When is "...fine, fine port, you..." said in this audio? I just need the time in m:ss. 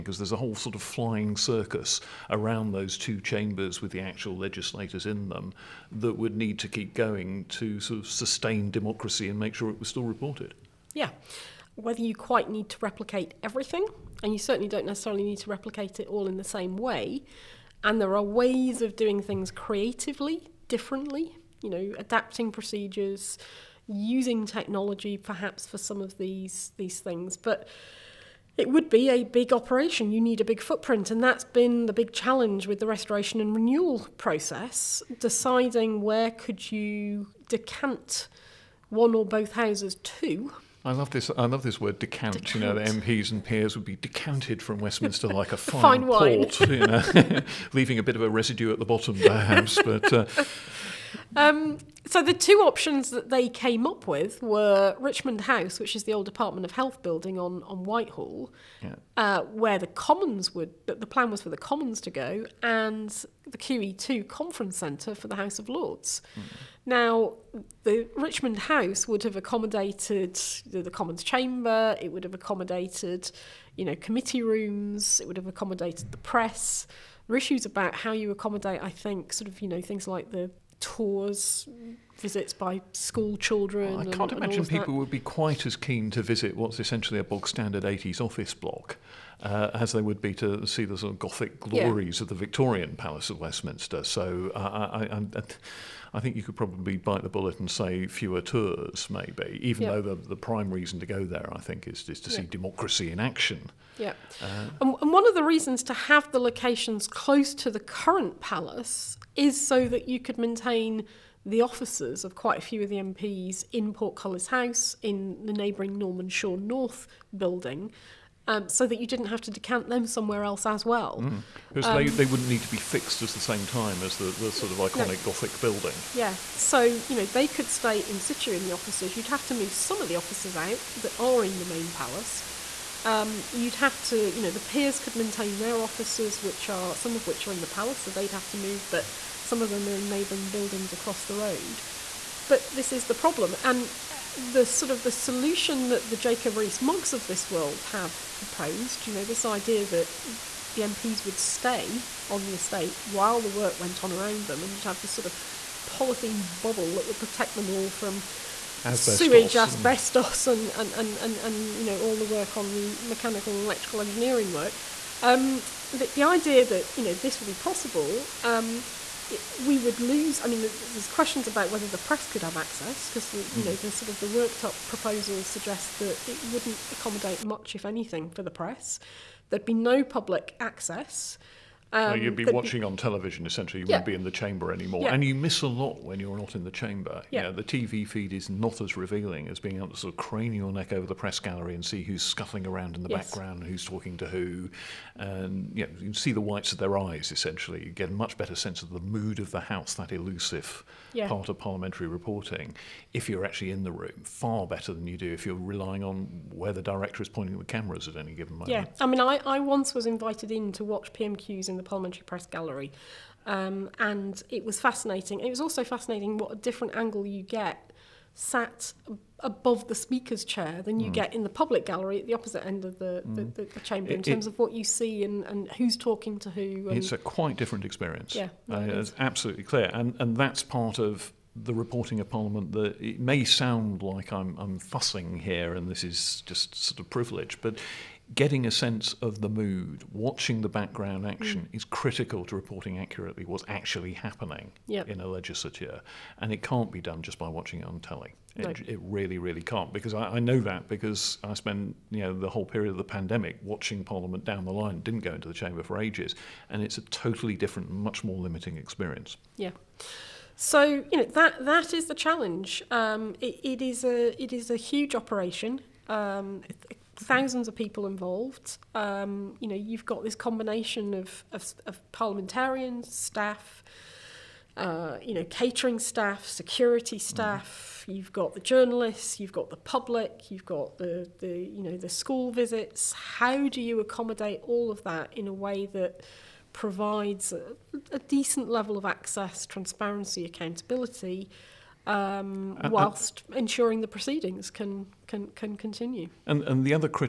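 0:45.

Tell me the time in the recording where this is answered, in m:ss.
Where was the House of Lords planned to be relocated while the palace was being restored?
1:03.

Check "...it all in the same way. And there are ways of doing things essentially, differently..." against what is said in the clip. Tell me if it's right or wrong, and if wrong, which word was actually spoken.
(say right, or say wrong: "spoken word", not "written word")
wrong: "creatively", not "essentially".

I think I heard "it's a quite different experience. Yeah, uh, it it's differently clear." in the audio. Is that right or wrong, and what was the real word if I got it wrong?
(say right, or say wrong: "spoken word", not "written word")
wrong: "absolutely", not "differently".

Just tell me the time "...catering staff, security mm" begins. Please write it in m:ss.
4:35.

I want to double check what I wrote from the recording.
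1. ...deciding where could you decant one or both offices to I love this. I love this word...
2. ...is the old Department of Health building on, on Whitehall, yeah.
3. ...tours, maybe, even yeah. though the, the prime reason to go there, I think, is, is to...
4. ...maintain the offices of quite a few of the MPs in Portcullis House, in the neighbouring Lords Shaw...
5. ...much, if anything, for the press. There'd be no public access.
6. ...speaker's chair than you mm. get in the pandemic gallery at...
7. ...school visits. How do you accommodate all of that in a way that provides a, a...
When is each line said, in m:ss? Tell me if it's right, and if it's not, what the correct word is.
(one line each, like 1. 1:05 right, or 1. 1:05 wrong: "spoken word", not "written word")
1. 0:35 wrong: "houses", not "offices"
2. 0:55 right
3. 1:38 right
4. 1:50 wrong: "Norman", not "Lords"
5. 2:57 right
6. 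3:39 wrong: "public", not "pandemic"
7. 4:42 right.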